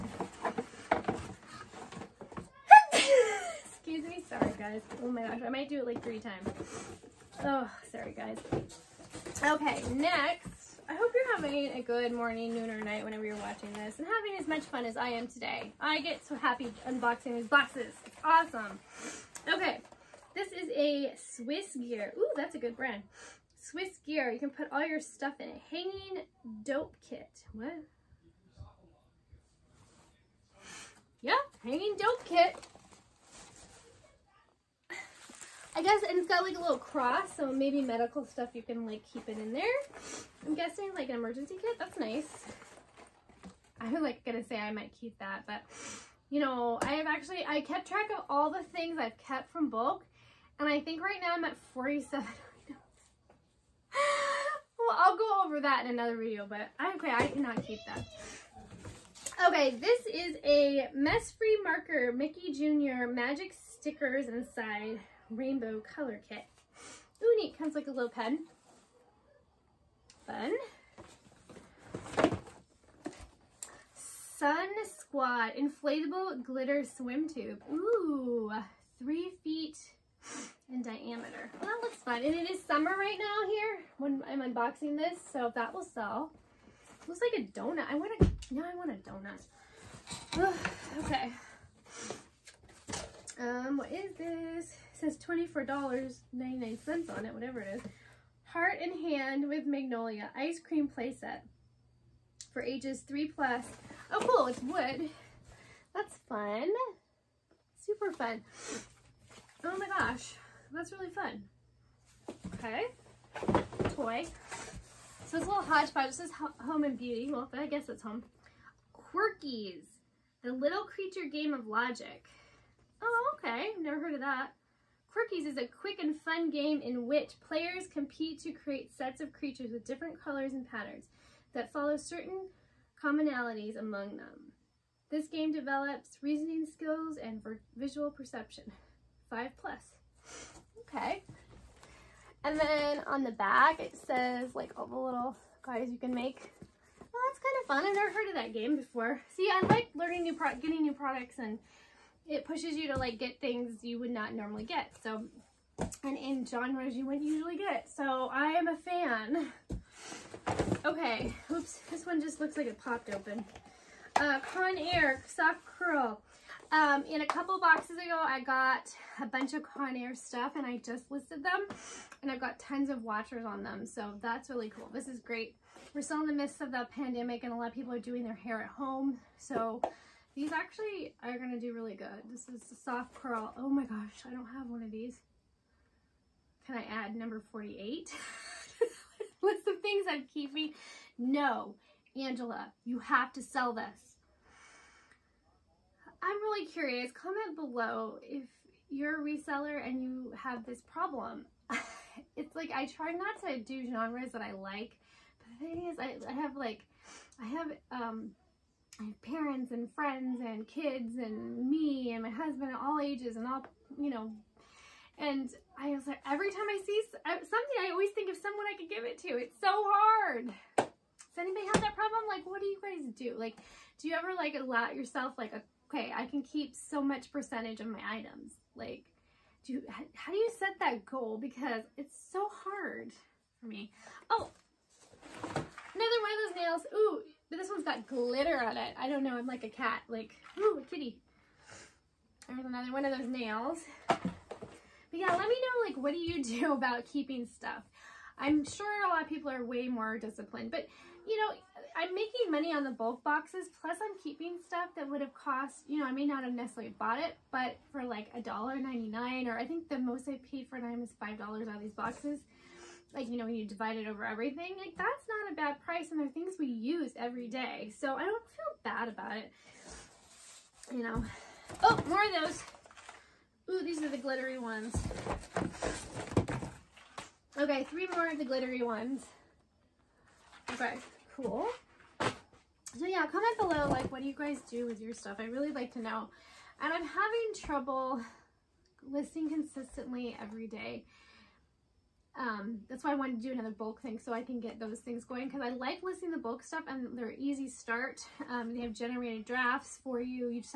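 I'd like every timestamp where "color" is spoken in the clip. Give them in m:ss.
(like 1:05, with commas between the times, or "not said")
1:05, 2:10.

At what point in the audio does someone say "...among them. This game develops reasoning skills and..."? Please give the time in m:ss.
2:13.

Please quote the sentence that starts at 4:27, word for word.
So I don't feel bad about it.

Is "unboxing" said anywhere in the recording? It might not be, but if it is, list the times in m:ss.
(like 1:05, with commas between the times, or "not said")
0:16, 1:24.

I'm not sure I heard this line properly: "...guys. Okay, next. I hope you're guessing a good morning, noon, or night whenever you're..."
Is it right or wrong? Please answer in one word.
wrong.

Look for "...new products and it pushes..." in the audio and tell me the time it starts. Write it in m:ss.
2:30.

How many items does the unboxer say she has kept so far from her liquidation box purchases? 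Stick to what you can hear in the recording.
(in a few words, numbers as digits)
47.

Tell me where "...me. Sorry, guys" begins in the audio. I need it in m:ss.
0:04.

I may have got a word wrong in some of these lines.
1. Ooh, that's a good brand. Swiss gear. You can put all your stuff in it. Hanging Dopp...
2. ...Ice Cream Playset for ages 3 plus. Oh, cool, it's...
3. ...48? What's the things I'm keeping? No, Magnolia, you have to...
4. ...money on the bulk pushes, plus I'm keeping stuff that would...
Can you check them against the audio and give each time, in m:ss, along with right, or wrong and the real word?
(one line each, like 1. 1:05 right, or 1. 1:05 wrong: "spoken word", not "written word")
1. 0:22 right
2. 1:40 right
3. 3:07 wrong: "Angela", not "Magnolia"
4. 4:12 wrong: "boxes", not "pushes".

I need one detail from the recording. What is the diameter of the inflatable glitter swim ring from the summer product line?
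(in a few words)
three feet.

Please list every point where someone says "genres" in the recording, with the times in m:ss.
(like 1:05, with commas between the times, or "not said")
2:36, 3:23.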